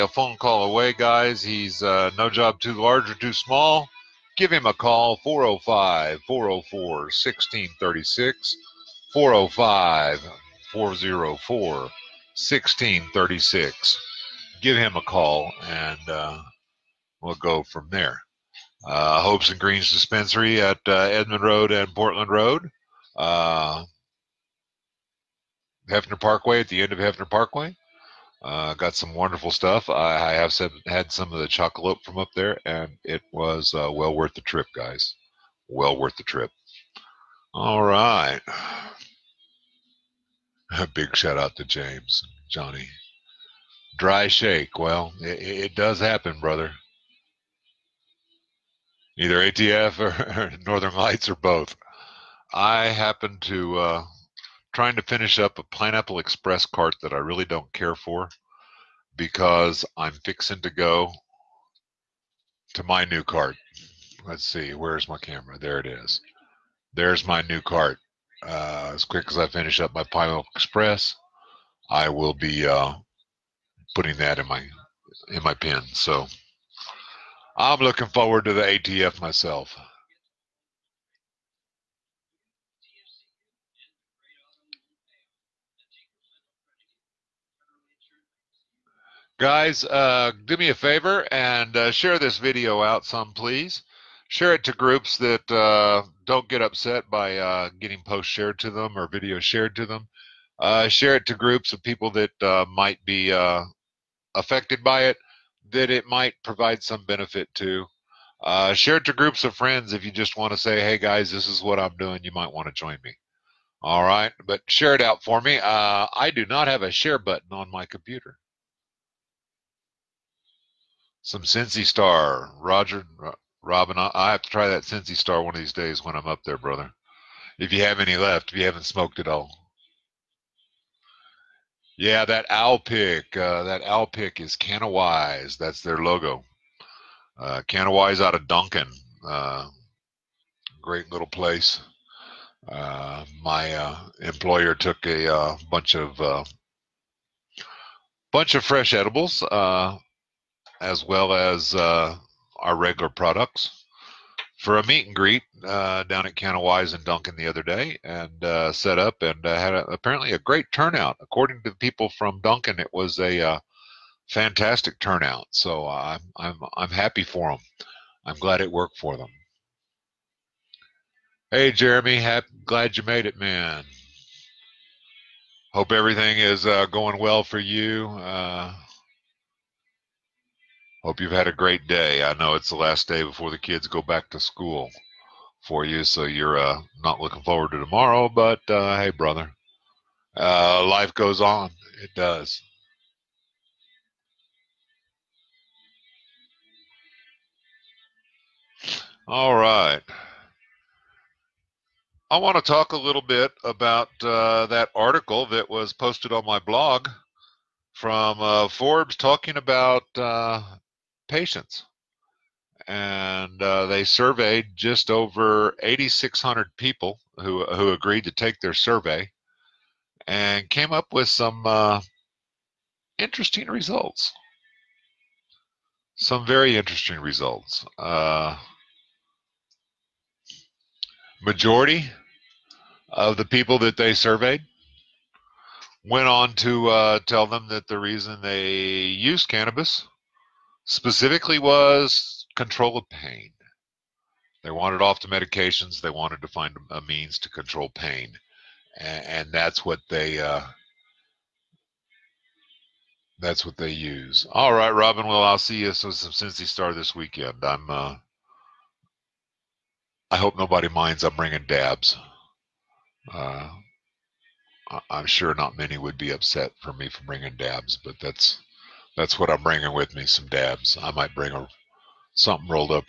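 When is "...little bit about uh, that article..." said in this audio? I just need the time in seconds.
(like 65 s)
202 s.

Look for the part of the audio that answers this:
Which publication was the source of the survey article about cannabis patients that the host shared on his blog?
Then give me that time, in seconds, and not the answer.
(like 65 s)
208 s.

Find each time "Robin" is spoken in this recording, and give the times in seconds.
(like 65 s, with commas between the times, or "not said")
123 s, 254 s.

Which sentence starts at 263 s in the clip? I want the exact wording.
Uh, I'm sure not many would be upset for me for bringing dabs, but that's that's what I'm bringing with me.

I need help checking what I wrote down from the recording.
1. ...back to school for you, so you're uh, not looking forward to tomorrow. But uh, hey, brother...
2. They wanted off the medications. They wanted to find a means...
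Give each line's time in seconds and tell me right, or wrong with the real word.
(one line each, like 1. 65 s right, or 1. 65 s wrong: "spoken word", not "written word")
1. 184 s right
2. 244 s right.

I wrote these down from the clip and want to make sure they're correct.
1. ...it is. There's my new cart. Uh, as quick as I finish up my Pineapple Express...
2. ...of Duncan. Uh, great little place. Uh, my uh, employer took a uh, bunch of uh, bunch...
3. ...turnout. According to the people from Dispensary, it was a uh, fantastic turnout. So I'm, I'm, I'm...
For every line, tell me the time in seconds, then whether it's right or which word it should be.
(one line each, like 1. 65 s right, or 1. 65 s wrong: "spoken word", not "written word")
1. 65 s right
2. 138 s right
3. 160 s wrong: "Duncan", not "Dispensary".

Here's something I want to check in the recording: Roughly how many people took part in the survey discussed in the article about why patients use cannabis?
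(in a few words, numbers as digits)
8,600.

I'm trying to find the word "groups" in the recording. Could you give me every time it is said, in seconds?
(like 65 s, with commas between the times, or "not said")
94 s, 101 s, 109 s.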